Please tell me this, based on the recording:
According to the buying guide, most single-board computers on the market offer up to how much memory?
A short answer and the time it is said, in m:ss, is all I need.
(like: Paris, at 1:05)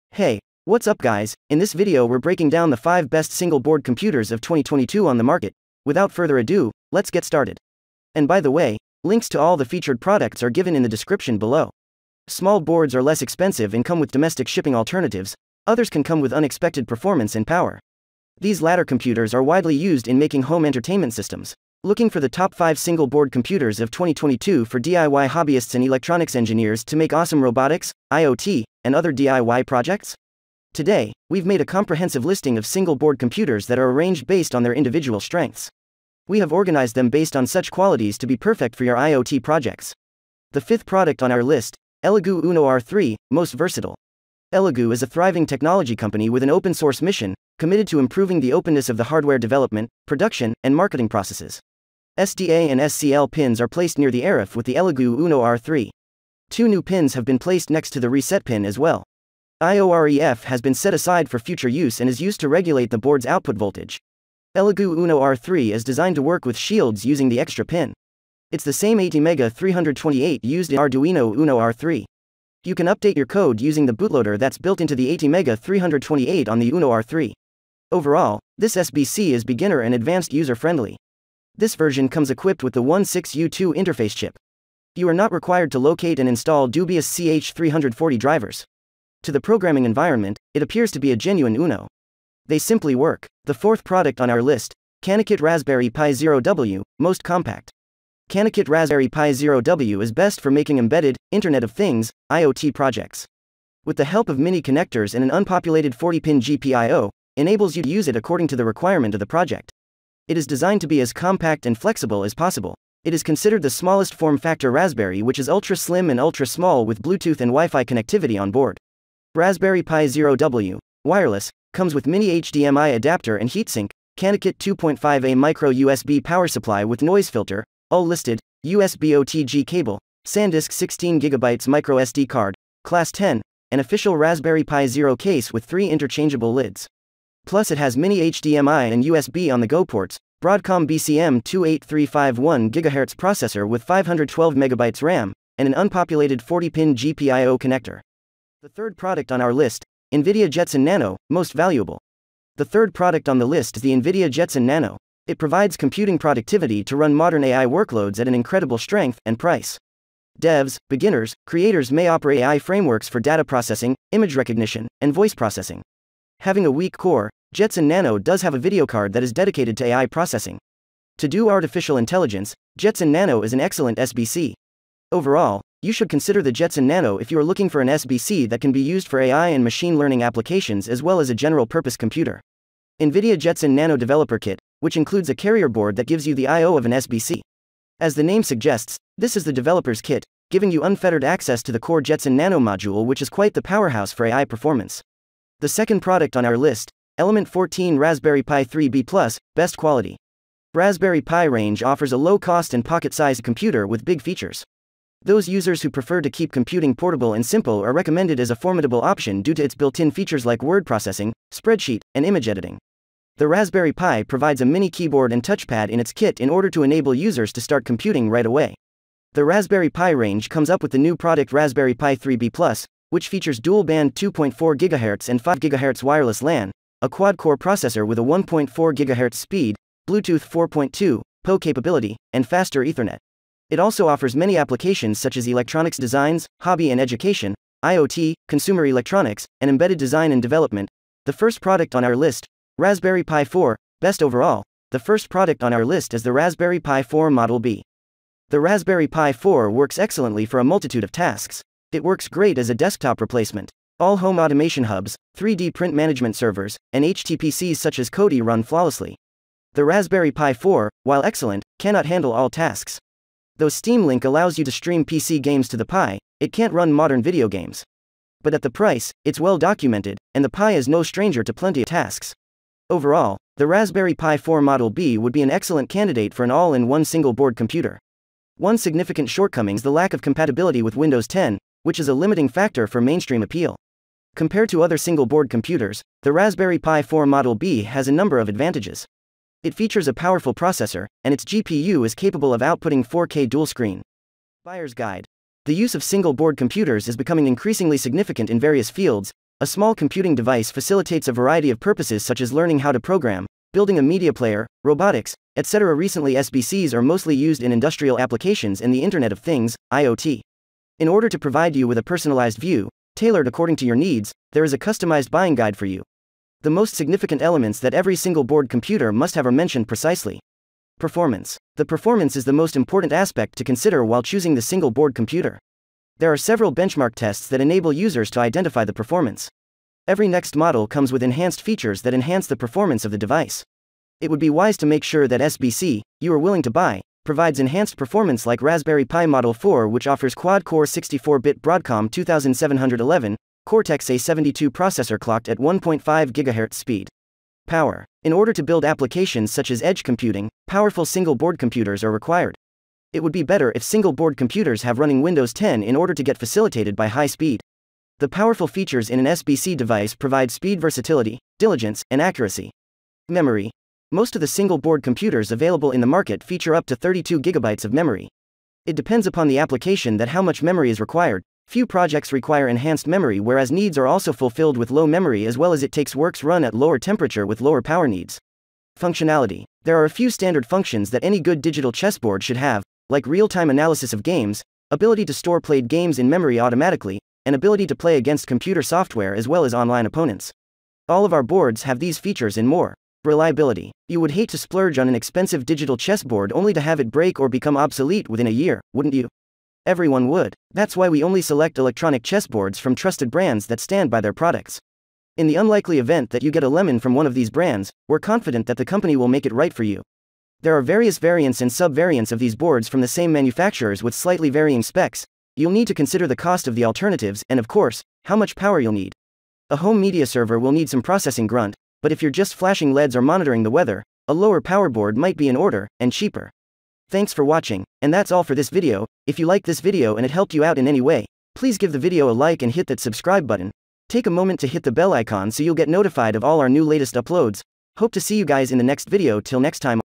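32 gigabytes, at 6:06.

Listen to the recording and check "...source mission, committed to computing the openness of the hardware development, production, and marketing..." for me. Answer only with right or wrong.
wrong.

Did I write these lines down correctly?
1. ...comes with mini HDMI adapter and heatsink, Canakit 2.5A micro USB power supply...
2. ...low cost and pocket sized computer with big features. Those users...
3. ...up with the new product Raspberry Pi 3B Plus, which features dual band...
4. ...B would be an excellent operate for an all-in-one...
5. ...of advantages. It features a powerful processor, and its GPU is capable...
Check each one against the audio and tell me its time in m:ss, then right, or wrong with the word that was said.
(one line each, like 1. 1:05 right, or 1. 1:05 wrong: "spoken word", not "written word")
1. 2:01 right
2. 3:22 right
3. 3:40 right
4. 4:34 wrong: "candidate", not "operate"
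5. 4:48 right.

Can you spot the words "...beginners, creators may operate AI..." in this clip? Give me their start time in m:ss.
2:40.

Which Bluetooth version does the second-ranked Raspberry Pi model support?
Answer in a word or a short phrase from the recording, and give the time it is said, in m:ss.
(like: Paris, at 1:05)
4.2, at 3:50.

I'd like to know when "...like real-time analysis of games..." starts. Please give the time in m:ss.
6:23.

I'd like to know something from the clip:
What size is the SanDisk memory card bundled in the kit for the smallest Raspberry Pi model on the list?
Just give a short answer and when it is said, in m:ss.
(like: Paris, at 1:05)
16GB, at 2:10.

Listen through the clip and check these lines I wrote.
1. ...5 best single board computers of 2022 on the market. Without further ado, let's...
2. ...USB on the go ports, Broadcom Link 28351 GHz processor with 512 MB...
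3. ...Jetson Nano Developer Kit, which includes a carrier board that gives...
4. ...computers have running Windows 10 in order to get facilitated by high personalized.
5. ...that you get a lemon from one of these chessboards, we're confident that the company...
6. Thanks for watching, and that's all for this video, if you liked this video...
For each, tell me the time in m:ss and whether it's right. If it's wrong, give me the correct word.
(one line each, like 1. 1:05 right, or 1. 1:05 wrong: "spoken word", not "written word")
1. 0:02 right
2. 2:19 wrong: "BCM", not "Link"
3. 3:03 right
4. 5:54 wrong: "speed", not "personalized"
5. 6:46 wrong: "brands", not "chessboards"
6. 7:07 right.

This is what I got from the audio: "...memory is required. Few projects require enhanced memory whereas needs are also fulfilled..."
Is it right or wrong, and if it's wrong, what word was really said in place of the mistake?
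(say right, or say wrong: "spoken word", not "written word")
right.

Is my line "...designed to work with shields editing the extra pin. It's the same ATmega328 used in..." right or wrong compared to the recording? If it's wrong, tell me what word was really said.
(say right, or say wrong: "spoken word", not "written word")
wrong: "using", not "editing".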